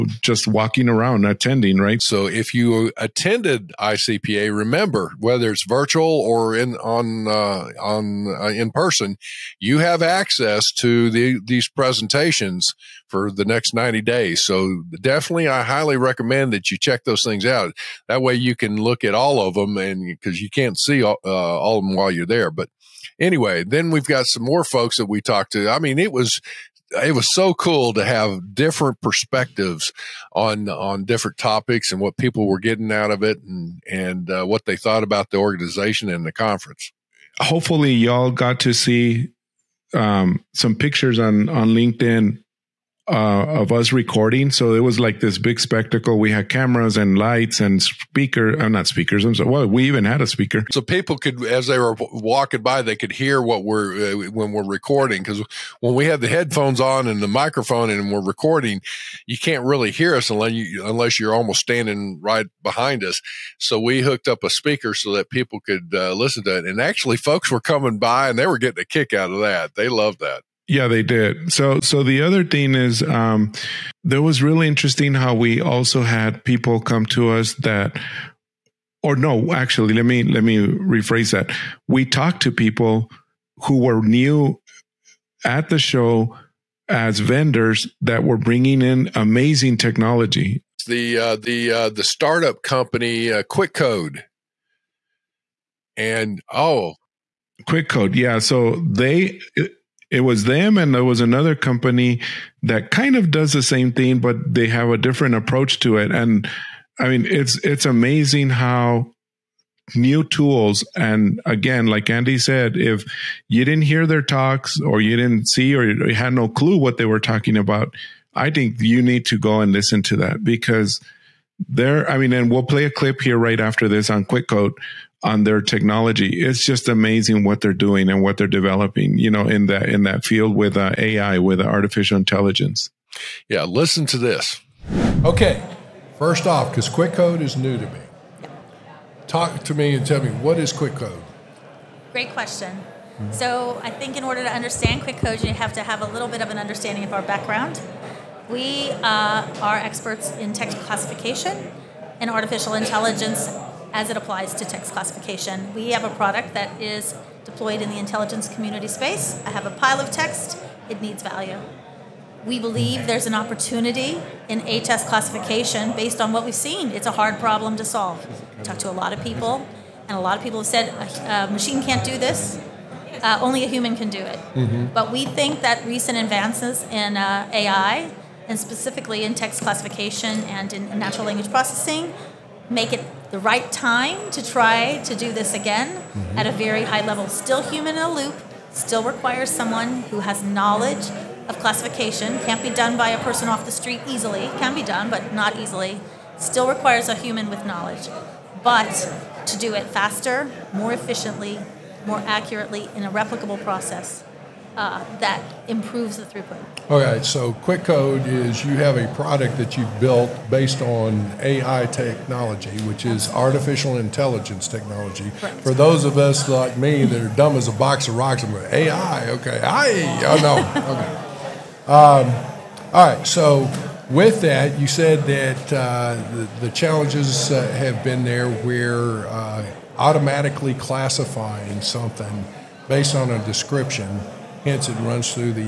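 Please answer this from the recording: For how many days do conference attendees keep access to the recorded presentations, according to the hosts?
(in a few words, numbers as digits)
90.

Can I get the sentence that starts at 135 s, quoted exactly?
Okay, first off, because Quick Code is new to me, talk to me and tell me what is Quick Code.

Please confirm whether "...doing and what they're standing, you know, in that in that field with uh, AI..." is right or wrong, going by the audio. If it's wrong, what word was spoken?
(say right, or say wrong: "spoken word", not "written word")
wrong: "developing", not "standing".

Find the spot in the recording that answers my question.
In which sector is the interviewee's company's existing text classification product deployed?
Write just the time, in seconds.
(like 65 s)
157 s.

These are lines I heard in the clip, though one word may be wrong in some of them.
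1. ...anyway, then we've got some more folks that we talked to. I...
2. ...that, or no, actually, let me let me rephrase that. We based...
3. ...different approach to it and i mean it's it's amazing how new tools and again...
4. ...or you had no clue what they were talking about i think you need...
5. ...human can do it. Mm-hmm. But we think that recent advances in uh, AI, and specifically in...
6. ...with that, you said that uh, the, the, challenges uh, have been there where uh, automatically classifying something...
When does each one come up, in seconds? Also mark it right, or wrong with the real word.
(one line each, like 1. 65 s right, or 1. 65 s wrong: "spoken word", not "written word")
1. 23 s right
2. 77 s wrong: "talked", not "based"
3. 104 s right
4. 115 s right
5. 173 s right
6. 224 s right.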